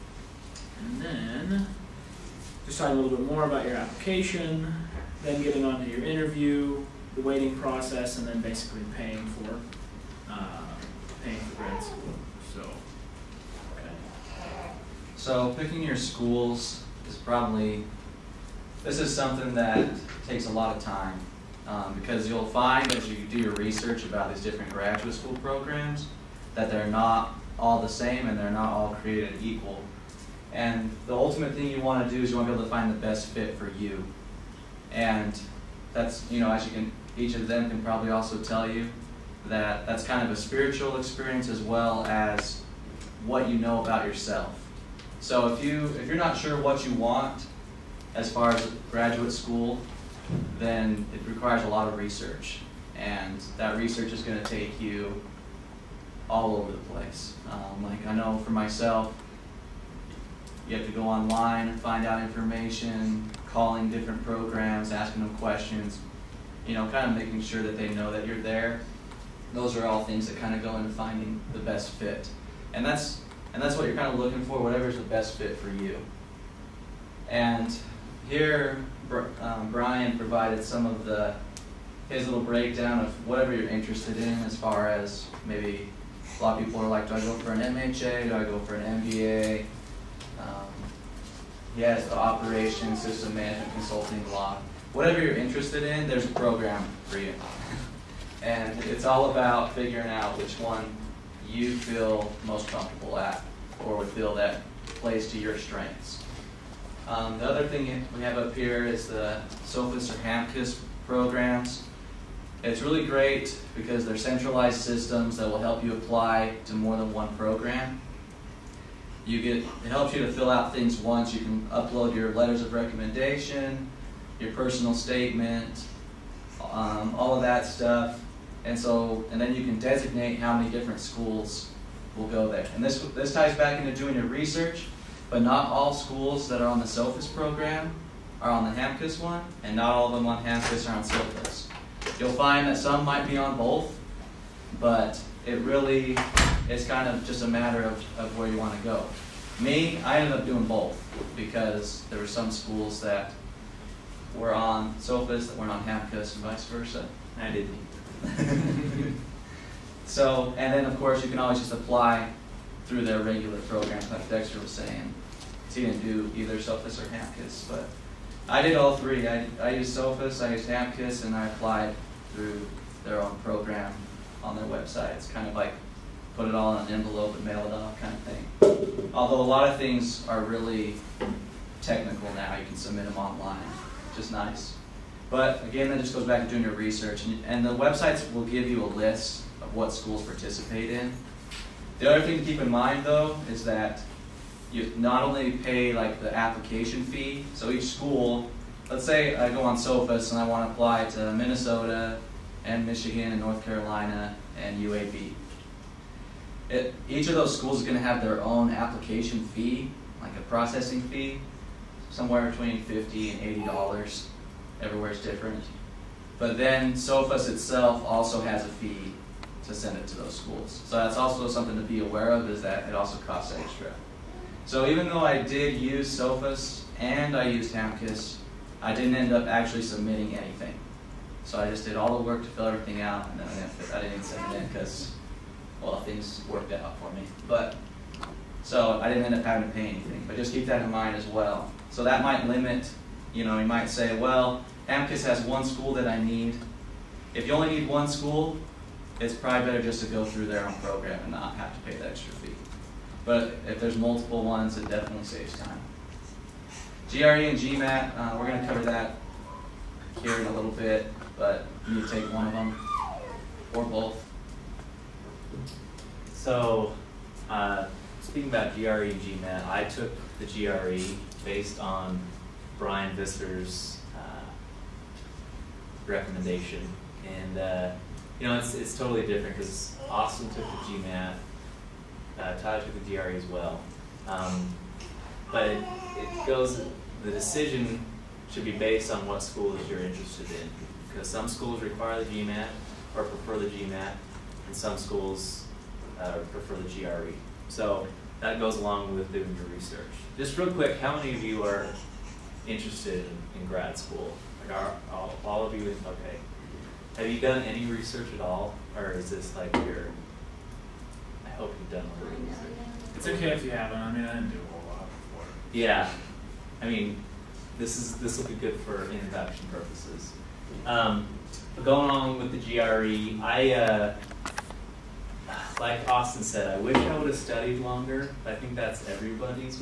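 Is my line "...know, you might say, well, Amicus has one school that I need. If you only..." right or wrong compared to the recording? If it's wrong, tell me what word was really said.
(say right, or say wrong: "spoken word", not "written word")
right.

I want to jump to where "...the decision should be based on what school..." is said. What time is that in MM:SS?
04:47.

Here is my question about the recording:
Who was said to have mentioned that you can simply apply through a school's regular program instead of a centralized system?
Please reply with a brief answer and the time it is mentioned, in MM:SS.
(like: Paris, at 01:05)
Dexter, at 02:44.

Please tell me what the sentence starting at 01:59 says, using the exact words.
You get, it helps you to fill out things once.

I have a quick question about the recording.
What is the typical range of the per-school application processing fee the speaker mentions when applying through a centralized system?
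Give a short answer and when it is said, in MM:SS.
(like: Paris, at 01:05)
50 to 80 dollars, at 03:32.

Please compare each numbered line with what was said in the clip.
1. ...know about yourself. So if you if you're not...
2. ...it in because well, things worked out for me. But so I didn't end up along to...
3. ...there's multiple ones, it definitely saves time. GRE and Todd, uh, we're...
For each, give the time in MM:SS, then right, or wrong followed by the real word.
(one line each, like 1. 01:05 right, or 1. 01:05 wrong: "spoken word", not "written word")
1. 00:43 right
2. 03:54 wrong: "having", not "along"
3. 04:13 wrong: "GMAT", not "Todd".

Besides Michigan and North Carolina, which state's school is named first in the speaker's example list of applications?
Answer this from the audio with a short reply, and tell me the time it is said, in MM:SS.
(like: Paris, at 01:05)
Minnesota, at 03:21.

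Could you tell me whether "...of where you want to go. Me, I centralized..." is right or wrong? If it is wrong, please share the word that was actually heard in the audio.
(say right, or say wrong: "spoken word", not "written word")
wrong: "ended", not "centralized".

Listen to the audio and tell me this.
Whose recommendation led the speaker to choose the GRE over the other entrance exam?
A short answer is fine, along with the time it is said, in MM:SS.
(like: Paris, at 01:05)
Brian Visser, at 04:32.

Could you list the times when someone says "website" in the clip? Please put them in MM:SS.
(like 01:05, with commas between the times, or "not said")
02:54, 03:07.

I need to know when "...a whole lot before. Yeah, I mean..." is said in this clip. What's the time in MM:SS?
05:14.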